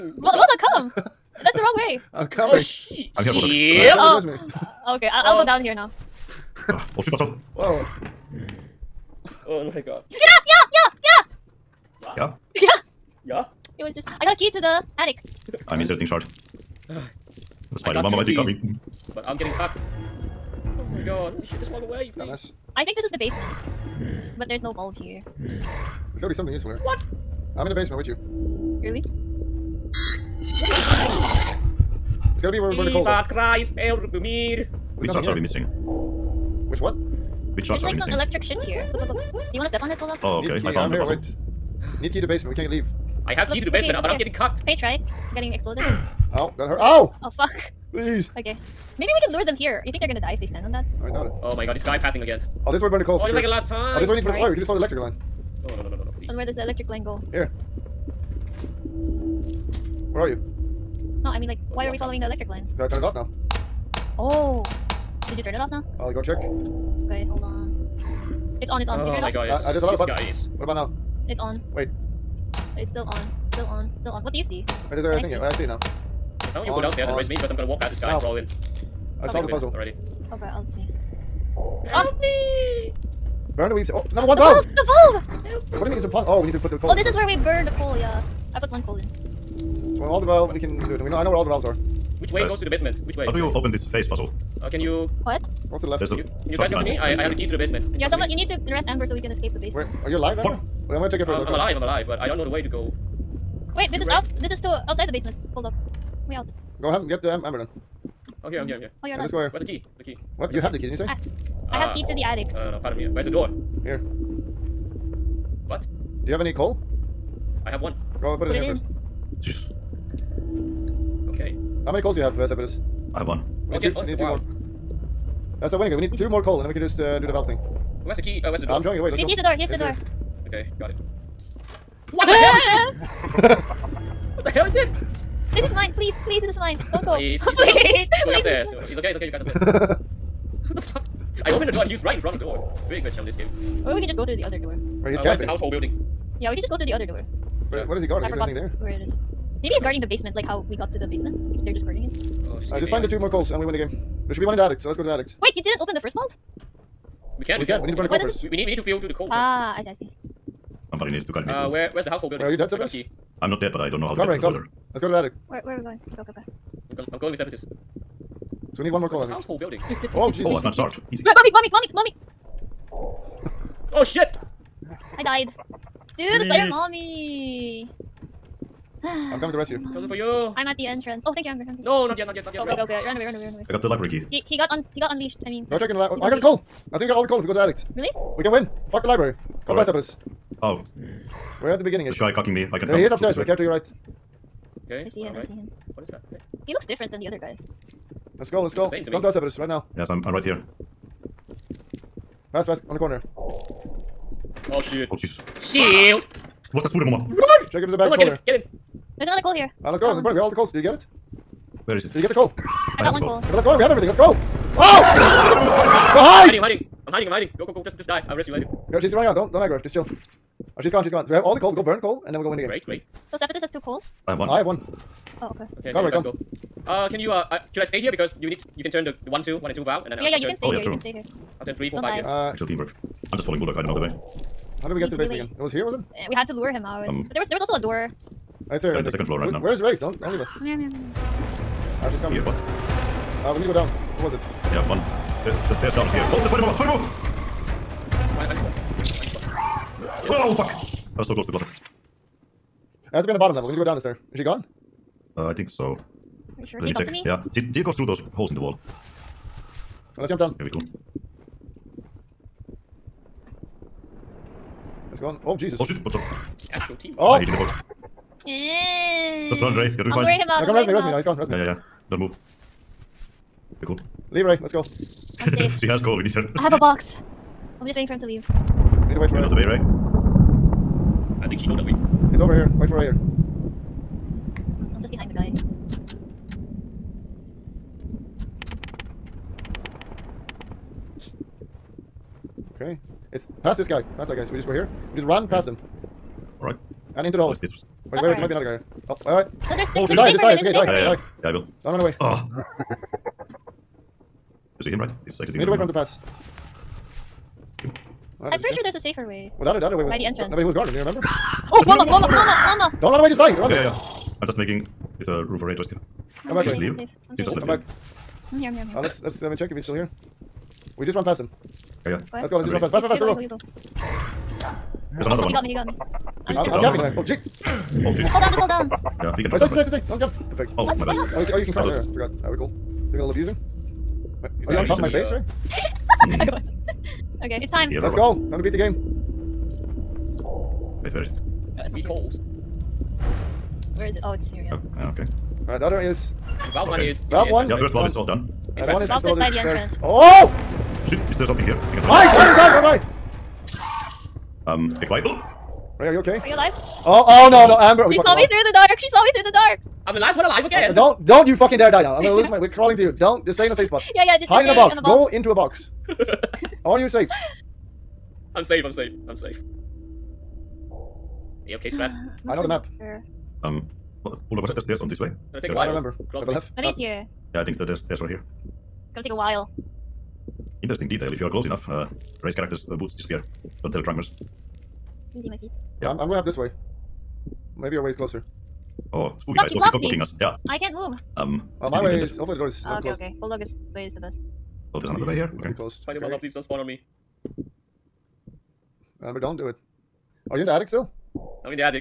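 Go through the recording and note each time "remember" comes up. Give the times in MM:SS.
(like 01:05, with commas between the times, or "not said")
05:11, 06:15.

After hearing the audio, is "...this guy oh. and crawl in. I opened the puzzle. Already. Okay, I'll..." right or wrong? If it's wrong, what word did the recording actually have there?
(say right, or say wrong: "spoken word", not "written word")
wrong: "solved", not "opened".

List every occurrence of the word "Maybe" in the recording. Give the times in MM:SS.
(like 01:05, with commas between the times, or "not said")
00:48, 02:29, 06:27.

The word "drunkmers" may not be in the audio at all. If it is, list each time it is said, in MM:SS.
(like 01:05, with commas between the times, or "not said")
06:24.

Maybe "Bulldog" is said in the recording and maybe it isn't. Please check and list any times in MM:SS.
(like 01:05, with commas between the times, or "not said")
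03:53, 06:14, 06:33.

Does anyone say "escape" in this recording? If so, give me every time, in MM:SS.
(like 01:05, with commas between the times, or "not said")
01:39, 05:15.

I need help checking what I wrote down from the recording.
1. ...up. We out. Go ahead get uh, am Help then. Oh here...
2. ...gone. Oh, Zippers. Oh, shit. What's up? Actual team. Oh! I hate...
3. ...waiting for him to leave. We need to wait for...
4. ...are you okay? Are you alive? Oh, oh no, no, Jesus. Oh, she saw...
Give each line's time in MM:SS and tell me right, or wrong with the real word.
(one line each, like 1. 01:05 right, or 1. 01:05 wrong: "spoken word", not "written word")
1. 01:45 wrong: "Amber", not "Help"
2. 04:25 wrong: "Jesus", not "Zippers"
3. 04:37 right
4. 05:56 wrong: "Amber", not "Jesus".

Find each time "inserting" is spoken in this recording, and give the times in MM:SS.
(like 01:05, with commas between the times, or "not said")
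00:15.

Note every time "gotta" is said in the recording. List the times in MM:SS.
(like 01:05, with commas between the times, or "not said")
00:26, 00:32.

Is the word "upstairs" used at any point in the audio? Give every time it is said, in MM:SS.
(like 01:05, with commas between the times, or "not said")
02:18, 03:13.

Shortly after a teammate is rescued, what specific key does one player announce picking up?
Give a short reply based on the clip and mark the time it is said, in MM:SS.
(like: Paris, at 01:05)
library key, at 03:03.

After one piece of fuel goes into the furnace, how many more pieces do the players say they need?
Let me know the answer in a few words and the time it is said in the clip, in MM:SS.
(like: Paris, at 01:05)
2, at 02:05.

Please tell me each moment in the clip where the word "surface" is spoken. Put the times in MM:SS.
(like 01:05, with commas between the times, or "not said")
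not said.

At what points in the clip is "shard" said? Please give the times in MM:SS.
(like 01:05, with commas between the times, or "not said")
00:16, 00:37.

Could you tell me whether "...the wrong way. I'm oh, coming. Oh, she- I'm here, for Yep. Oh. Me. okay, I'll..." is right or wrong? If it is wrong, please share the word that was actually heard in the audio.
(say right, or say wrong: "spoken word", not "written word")
right.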